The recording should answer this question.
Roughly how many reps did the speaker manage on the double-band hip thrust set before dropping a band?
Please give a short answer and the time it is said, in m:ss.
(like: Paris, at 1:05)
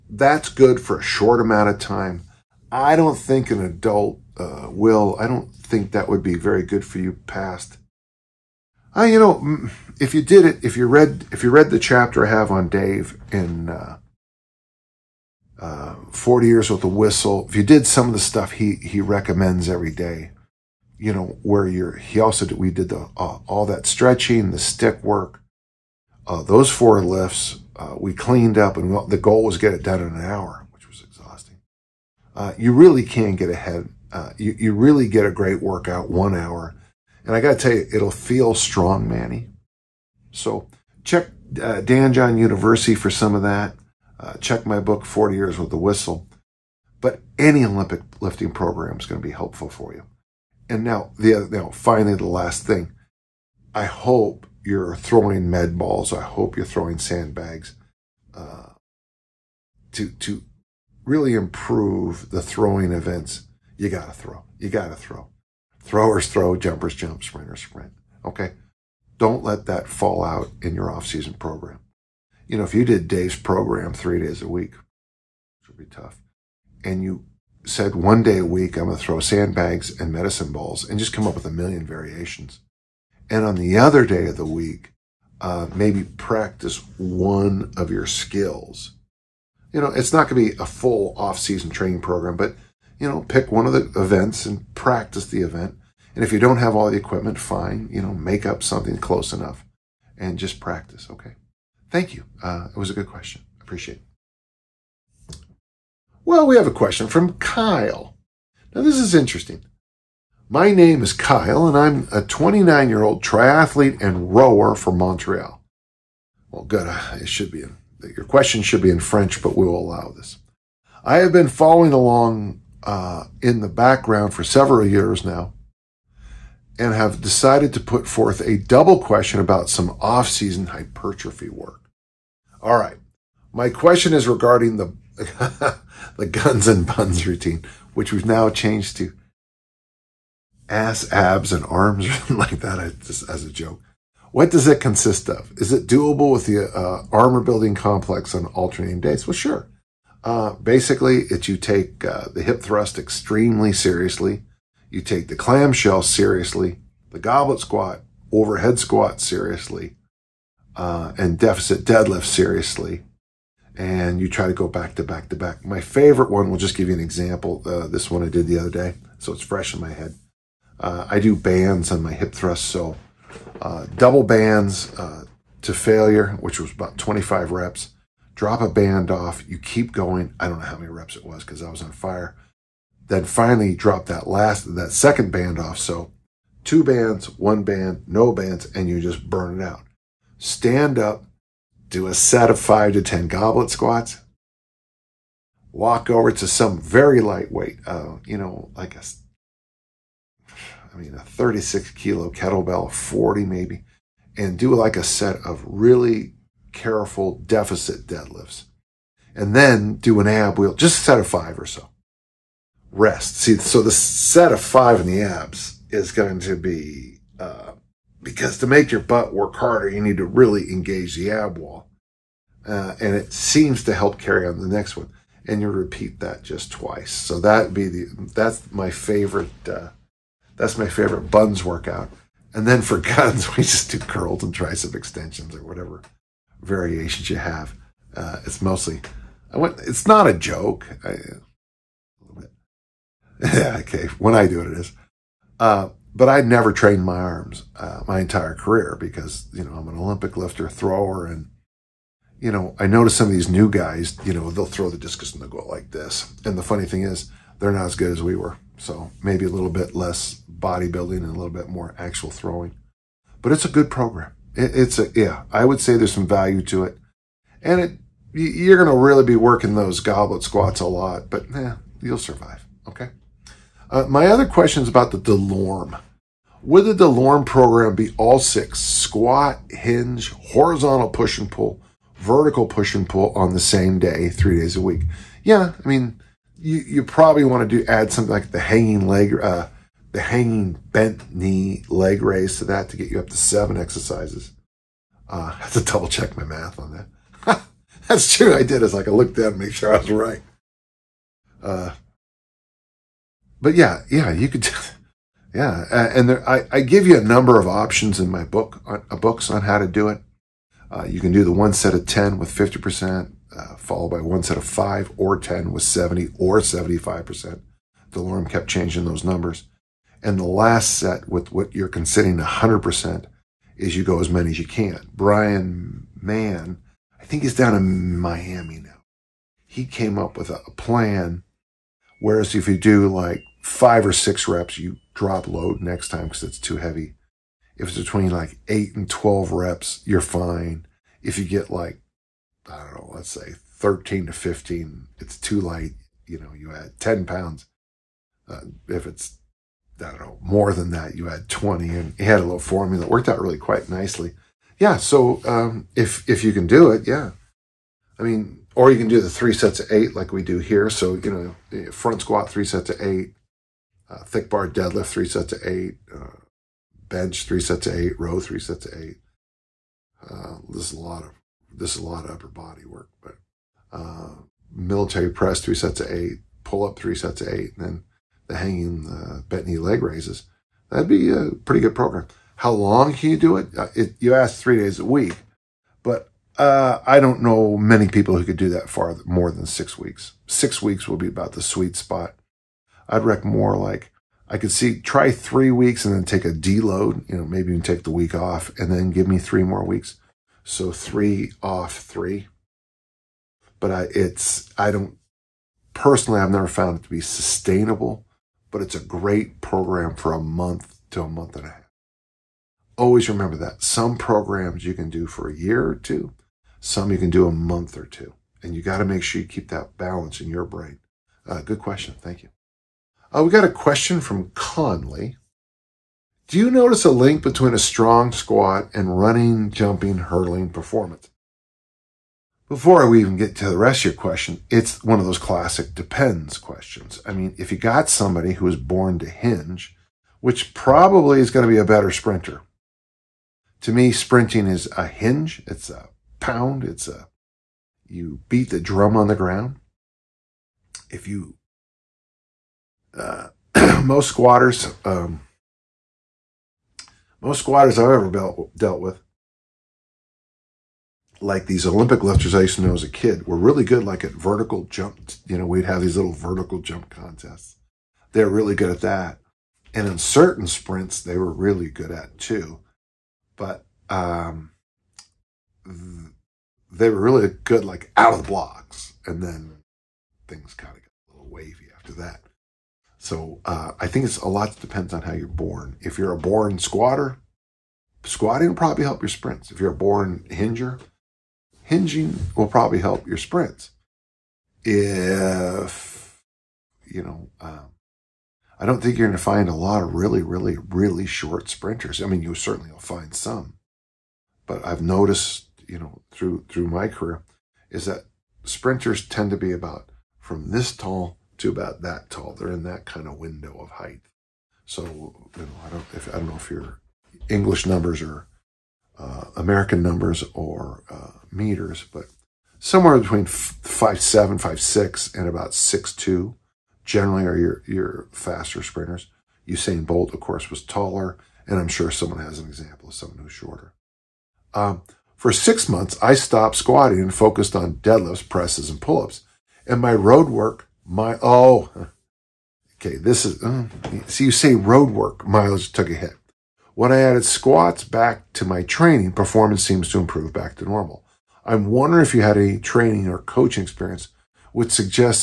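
25, at 2:56.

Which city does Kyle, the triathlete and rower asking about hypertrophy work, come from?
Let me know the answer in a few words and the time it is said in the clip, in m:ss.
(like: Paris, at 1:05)
Montreal, at 1:54.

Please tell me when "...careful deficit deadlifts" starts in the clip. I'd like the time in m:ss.
3:26.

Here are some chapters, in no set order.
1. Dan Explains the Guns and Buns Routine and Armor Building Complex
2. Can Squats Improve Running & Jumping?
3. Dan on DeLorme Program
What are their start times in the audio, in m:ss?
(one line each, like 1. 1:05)
1. 1:43
2. 7:01
3. 4:37.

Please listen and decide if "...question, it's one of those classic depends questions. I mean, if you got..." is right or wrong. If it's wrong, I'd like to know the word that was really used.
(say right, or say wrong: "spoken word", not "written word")
right.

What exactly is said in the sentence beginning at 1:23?
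And on the other day of the week, uh, maybe practice one of your skills.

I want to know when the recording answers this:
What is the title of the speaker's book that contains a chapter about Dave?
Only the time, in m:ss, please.
0:16.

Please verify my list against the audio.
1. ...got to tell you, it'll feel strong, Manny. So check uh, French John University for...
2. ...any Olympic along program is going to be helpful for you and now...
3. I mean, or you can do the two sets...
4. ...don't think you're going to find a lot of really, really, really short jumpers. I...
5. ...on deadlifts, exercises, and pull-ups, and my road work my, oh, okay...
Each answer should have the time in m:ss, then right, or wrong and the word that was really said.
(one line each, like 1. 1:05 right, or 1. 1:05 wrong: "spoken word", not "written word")
1. 0:37 wrong: "Dan", not "French"
2. 0:47 wrong: "lifting", not "along"
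3. 5:58 wrong: "three", not "two"
4. 8:18 wrong: "sprinters", not "jumpers"
5. 8:57 wrong: "presses", not "exercises".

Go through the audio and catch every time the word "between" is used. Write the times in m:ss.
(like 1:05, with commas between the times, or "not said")
5:37, 7:07, 8:43.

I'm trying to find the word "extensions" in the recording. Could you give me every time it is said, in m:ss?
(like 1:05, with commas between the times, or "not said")
3:54.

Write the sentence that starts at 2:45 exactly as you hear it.
My favorite one, we'll just give you an example.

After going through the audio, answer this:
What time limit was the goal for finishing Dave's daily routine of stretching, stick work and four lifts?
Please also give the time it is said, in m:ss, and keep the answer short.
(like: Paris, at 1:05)
an hour, at 0:30.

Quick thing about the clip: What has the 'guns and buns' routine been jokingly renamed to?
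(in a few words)
ass, abs, and arms.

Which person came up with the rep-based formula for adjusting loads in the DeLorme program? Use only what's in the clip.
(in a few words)
Bryan Mann.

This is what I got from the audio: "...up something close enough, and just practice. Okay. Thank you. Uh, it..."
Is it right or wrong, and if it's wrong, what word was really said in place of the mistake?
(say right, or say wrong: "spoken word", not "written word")
right.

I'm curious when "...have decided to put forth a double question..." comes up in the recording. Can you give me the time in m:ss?
2:06.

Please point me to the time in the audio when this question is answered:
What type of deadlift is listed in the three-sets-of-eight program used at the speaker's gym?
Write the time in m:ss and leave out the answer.
6:04.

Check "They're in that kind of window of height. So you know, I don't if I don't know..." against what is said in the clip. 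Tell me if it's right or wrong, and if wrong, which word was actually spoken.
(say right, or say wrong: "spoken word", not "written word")
right.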